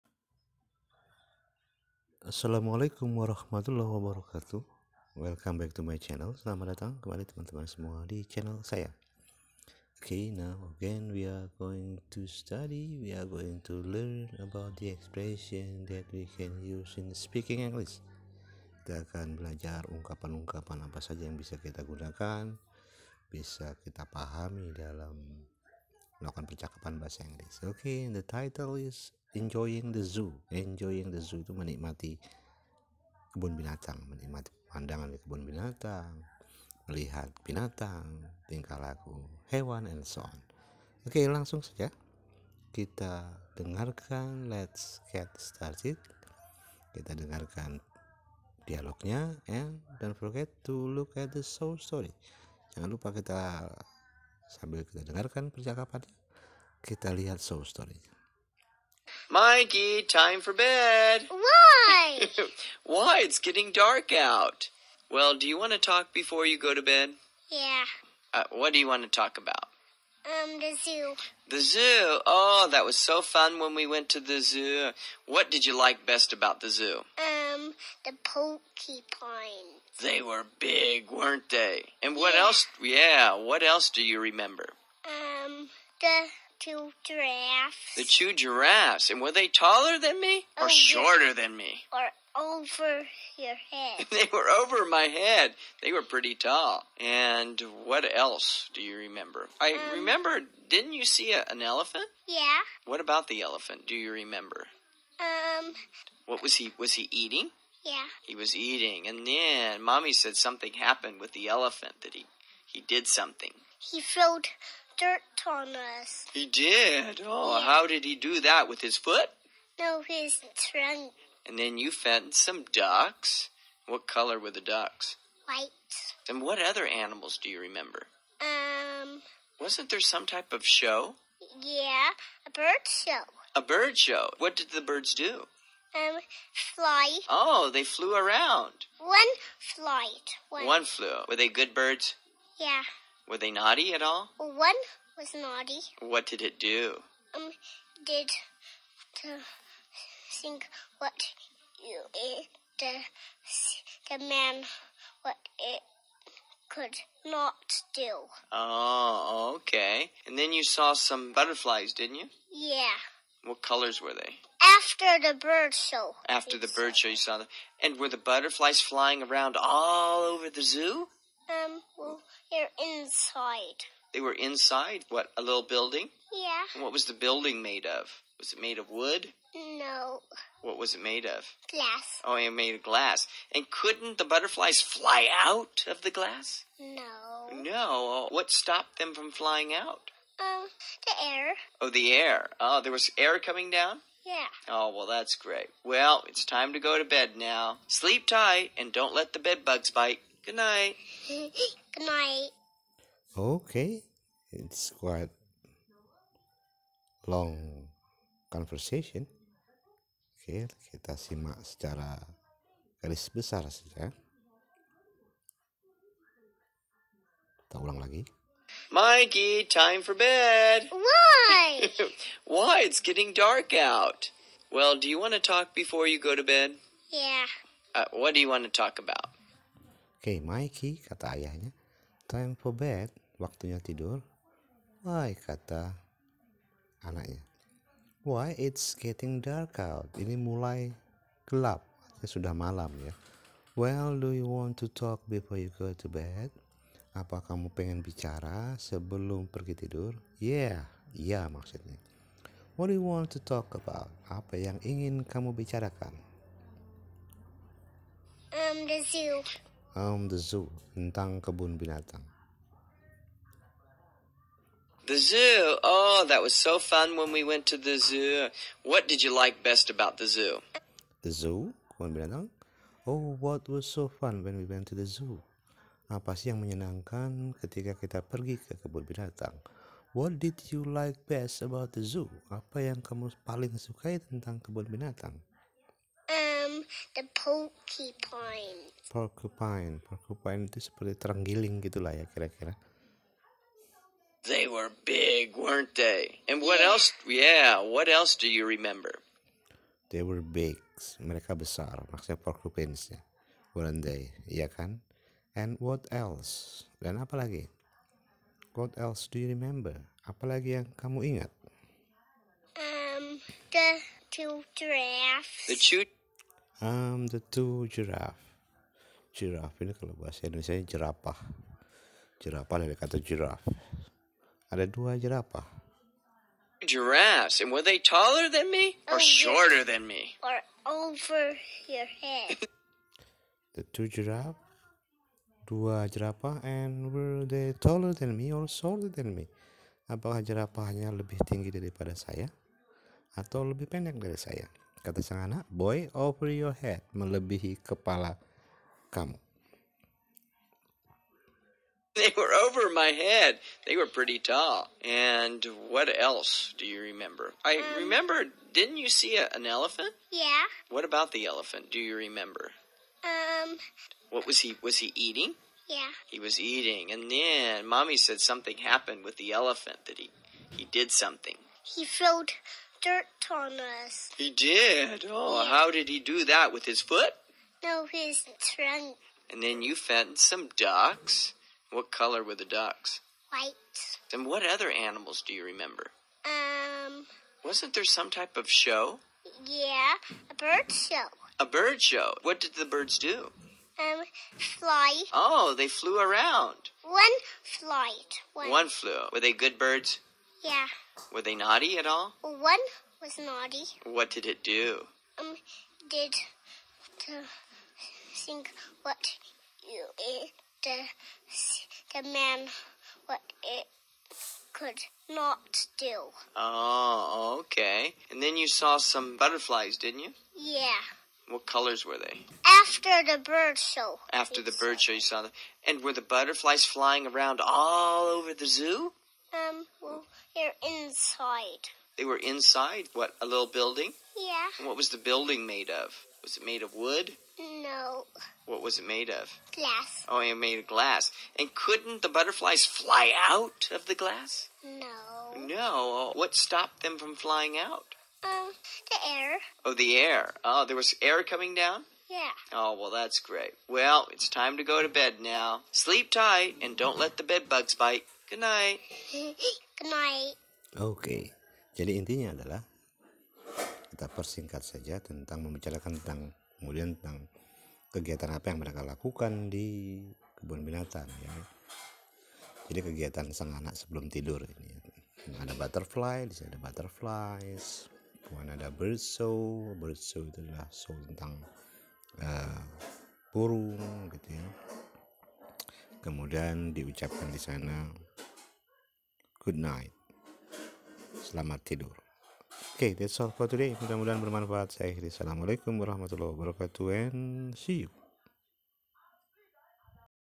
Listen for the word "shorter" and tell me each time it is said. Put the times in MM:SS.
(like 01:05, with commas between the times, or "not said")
01:30, 05:29, 05:38.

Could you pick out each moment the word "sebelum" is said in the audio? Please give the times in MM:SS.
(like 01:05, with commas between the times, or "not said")
04:08, 07:53.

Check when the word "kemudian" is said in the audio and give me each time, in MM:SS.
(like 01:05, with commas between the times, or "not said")
07:46, 07:58, 08:06.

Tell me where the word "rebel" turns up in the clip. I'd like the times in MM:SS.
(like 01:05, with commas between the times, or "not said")
not said.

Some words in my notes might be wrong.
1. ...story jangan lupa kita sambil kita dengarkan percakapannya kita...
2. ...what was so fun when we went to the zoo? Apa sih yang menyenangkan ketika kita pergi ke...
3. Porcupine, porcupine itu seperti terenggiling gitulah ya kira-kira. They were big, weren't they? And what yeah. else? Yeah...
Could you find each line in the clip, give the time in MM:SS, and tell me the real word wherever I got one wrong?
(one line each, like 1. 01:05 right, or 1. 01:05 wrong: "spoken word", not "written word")
1. 00:51 right
2. 04:33 right
3. 04:49 right.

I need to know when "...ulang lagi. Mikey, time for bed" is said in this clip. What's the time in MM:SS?
03:37.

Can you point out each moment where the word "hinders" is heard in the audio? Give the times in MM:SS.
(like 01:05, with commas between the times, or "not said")
not said.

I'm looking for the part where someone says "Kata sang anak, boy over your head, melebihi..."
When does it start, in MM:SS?
05:45.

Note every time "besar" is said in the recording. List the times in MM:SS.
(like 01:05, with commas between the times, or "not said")
03:33, 05:01.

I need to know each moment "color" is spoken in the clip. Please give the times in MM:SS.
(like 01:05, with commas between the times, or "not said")
02:04, 02:43, 06:22, 07:01.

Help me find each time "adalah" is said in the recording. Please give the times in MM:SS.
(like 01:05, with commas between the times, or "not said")
07:42, 08:00.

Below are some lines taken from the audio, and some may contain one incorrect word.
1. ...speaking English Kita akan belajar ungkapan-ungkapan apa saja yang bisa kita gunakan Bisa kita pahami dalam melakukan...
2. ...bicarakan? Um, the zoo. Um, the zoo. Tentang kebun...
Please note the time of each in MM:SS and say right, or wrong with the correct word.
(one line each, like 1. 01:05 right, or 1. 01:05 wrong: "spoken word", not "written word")
1. 00:17 right
2. 04:15 right.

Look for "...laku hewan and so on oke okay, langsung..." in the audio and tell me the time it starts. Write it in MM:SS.
00:38.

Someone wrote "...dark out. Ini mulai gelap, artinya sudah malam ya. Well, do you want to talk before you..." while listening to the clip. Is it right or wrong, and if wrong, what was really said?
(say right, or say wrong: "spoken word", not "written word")
right.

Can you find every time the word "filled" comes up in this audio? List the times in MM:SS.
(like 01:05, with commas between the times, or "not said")
01:53, 06:12.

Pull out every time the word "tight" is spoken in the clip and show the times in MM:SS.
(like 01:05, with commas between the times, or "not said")
03:18, 07:36.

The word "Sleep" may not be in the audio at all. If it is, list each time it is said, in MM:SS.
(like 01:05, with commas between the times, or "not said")
03:17, 07:35.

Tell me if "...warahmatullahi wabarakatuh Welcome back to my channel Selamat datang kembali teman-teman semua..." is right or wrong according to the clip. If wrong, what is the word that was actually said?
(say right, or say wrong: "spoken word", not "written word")
right.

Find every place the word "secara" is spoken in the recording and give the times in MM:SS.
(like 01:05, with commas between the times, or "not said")
03:31.